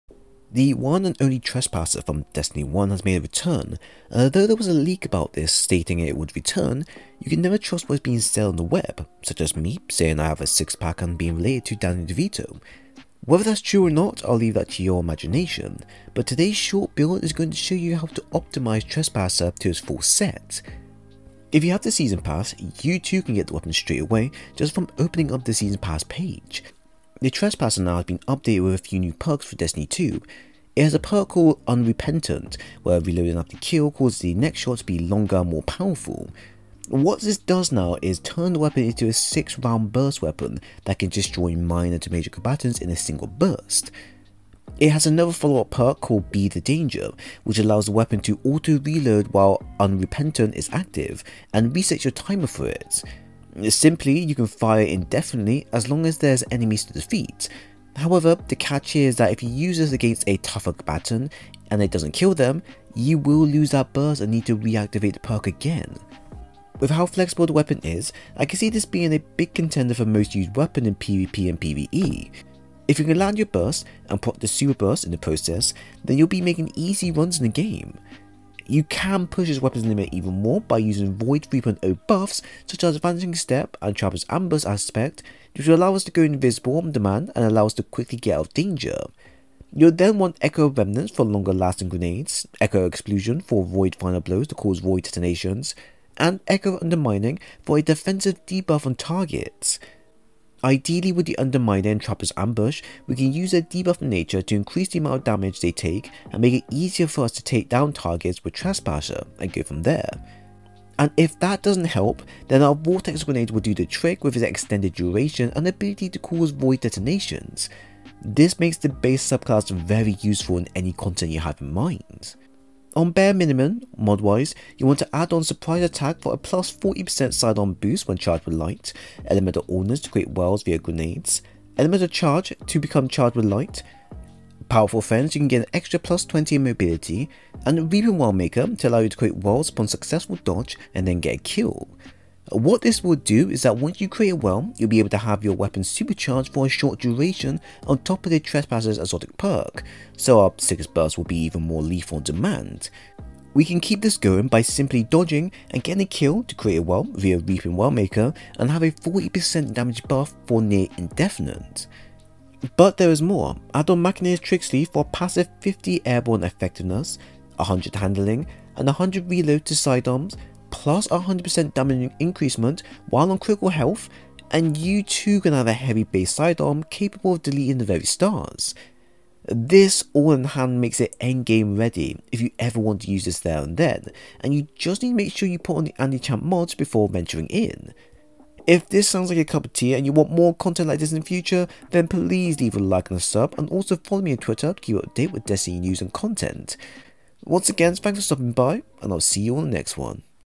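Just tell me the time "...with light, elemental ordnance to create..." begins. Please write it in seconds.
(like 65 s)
128 s.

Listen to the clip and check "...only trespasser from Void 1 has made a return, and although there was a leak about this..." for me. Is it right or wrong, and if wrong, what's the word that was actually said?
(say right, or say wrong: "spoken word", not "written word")
wrong: "Destiny", not "Void".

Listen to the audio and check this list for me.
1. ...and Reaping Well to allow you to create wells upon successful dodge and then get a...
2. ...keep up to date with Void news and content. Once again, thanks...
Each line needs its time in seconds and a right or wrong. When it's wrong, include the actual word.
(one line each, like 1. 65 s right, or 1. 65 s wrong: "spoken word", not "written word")
1. 137 s right
2. 194 s wrong: "Destiny", not "Void".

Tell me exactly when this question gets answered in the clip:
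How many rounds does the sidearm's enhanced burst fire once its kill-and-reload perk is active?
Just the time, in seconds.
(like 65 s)
39 s.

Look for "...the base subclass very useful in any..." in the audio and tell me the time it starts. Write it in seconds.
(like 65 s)
118 s.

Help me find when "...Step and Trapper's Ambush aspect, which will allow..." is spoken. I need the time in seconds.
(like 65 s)
83 s.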